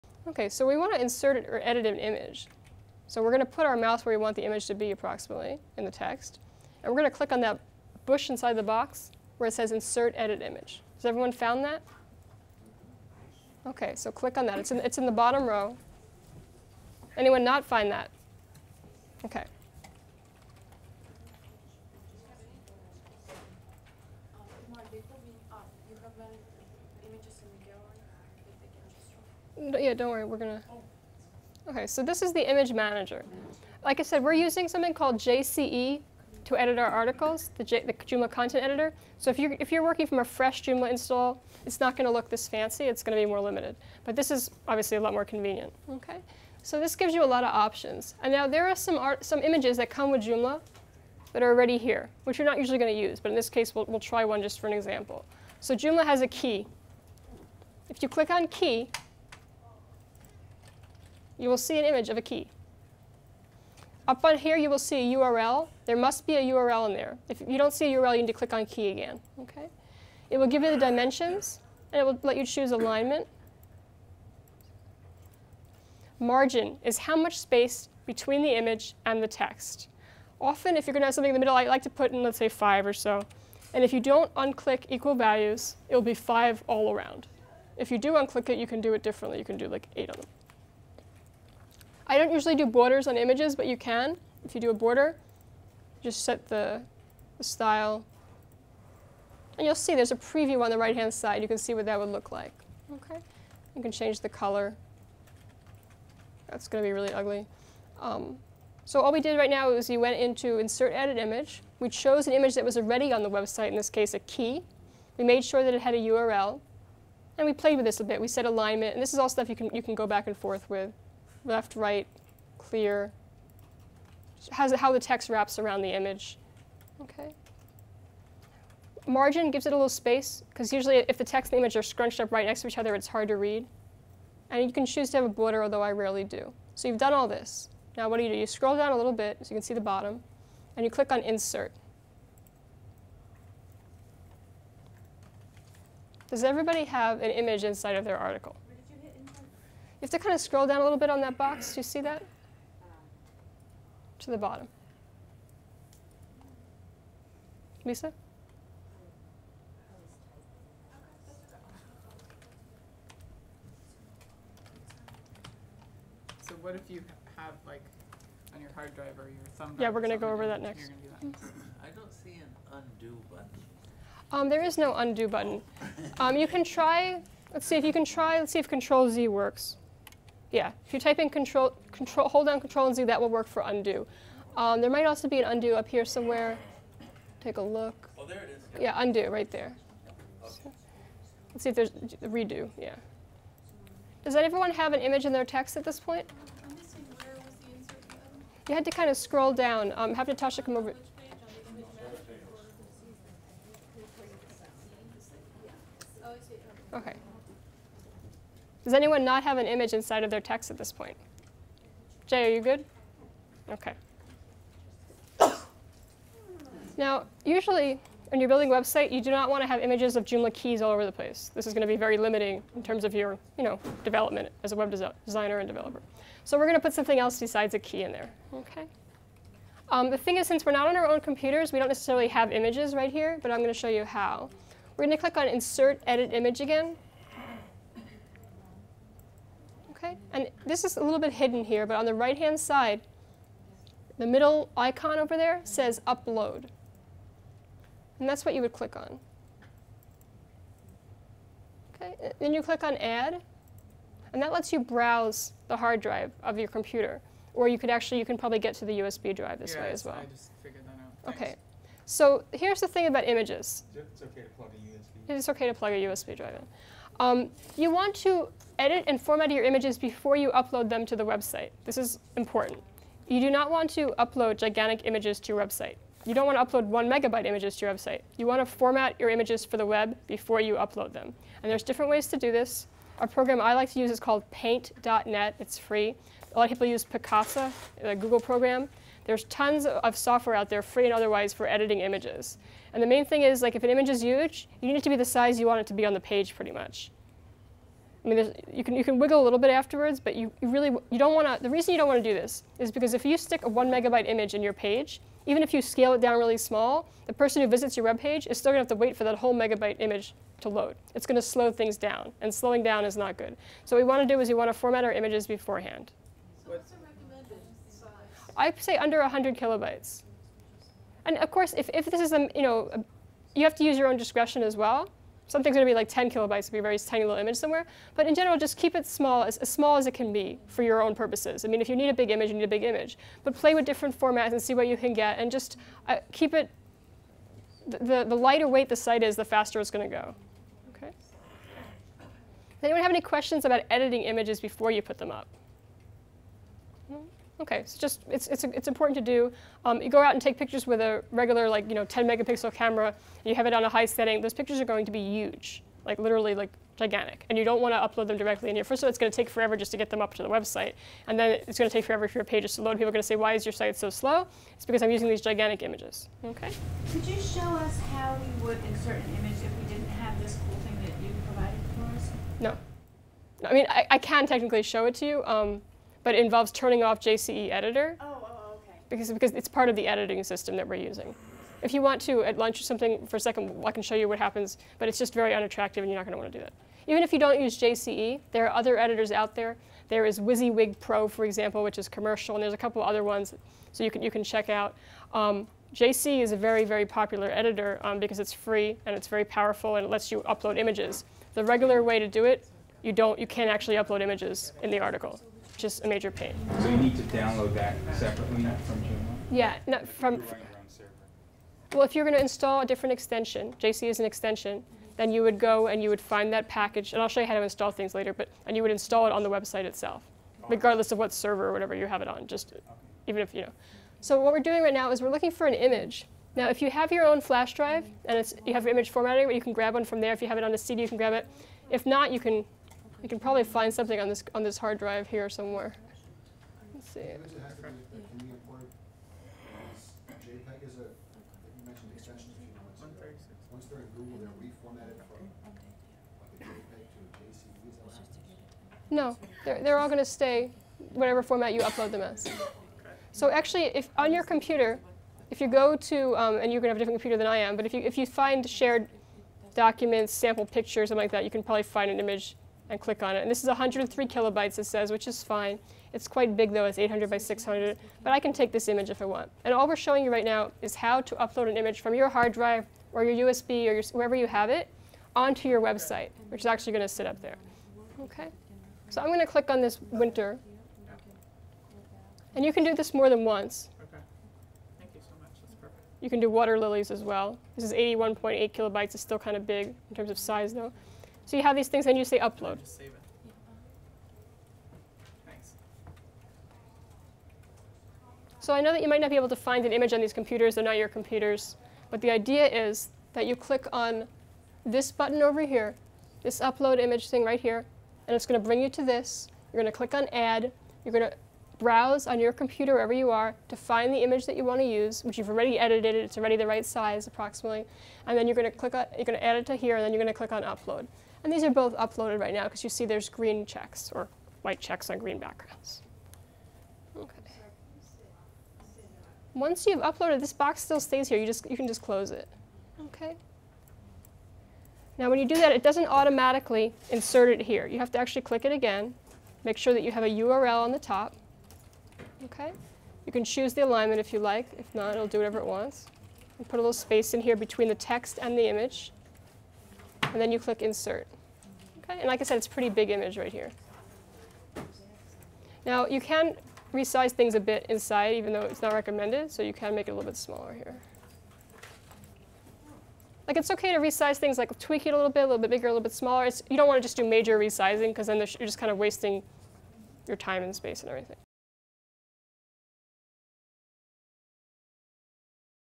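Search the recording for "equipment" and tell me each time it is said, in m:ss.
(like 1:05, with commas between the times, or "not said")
not said.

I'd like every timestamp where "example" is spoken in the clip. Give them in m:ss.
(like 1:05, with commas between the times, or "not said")
0:54, 6:31.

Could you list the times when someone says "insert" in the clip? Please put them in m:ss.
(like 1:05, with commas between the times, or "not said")
0:01, 0:09, 1:50, 2:21, 3:55, 6:08, 8:57, 9:10.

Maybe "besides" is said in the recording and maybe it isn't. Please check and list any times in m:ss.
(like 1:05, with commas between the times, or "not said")
3:47.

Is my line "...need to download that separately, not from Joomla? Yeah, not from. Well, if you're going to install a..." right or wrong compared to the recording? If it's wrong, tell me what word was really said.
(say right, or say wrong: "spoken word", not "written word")
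right.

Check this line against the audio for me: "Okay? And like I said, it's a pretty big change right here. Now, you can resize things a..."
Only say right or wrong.
wrong.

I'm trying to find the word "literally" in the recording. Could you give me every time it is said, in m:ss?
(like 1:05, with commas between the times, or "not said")
5:56.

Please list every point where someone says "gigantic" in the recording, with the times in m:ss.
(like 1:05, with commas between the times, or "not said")
4:34, 5:56, 6:05.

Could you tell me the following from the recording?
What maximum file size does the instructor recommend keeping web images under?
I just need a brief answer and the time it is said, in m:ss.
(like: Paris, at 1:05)
100 kilobytes, at 5:18.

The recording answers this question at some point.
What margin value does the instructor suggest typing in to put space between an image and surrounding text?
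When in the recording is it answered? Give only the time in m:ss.
1:22.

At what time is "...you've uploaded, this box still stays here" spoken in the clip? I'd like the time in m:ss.
8:49.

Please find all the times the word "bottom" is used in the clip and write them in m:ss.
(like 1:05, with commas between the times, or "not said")
0:15, 2:19, 2:34.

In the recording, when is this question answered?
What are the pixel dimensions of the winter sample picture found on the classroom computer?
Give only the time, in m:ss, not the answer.
7:46.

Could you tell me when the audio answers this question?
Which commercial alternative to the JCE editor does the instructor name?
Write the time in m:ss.
6:30.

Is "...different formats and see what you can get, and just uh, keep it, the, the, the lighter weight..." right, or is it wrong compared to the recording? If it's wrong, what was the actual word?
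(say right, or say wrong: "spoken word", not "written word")
right.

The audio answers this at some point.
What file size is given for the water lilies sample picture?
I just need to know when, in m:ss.
8:07.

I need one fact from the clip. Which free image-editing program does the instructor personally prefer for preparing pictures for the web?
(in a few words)
paint.net.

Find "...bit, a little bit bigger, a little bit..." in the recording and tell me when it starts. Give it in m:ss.
9:25.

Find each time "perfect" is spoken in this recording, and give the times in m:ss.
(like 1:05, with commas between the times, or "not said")
8:05.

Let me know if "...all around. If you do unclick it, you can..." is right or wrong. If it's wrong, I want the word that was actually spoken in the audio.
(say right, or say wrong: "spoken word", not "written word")
right.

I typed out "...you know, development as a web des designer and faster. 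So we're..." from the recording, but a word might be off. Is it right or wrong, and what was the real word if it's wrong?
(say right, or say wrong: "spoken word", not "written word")
wrong: "developer", not "faster".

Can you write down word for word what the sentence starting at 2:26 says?
Does everybody have an image inside of their article?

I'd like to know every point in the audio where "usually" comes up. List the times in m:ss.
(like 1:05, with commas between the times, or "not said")
0:52, 1:32, 2:10, 3:37.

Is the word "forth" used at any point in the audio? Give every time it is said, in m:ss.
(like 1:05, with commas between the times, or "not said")
2:00.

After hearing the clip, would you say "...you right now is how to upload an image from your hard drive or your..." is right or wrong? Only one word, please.
right.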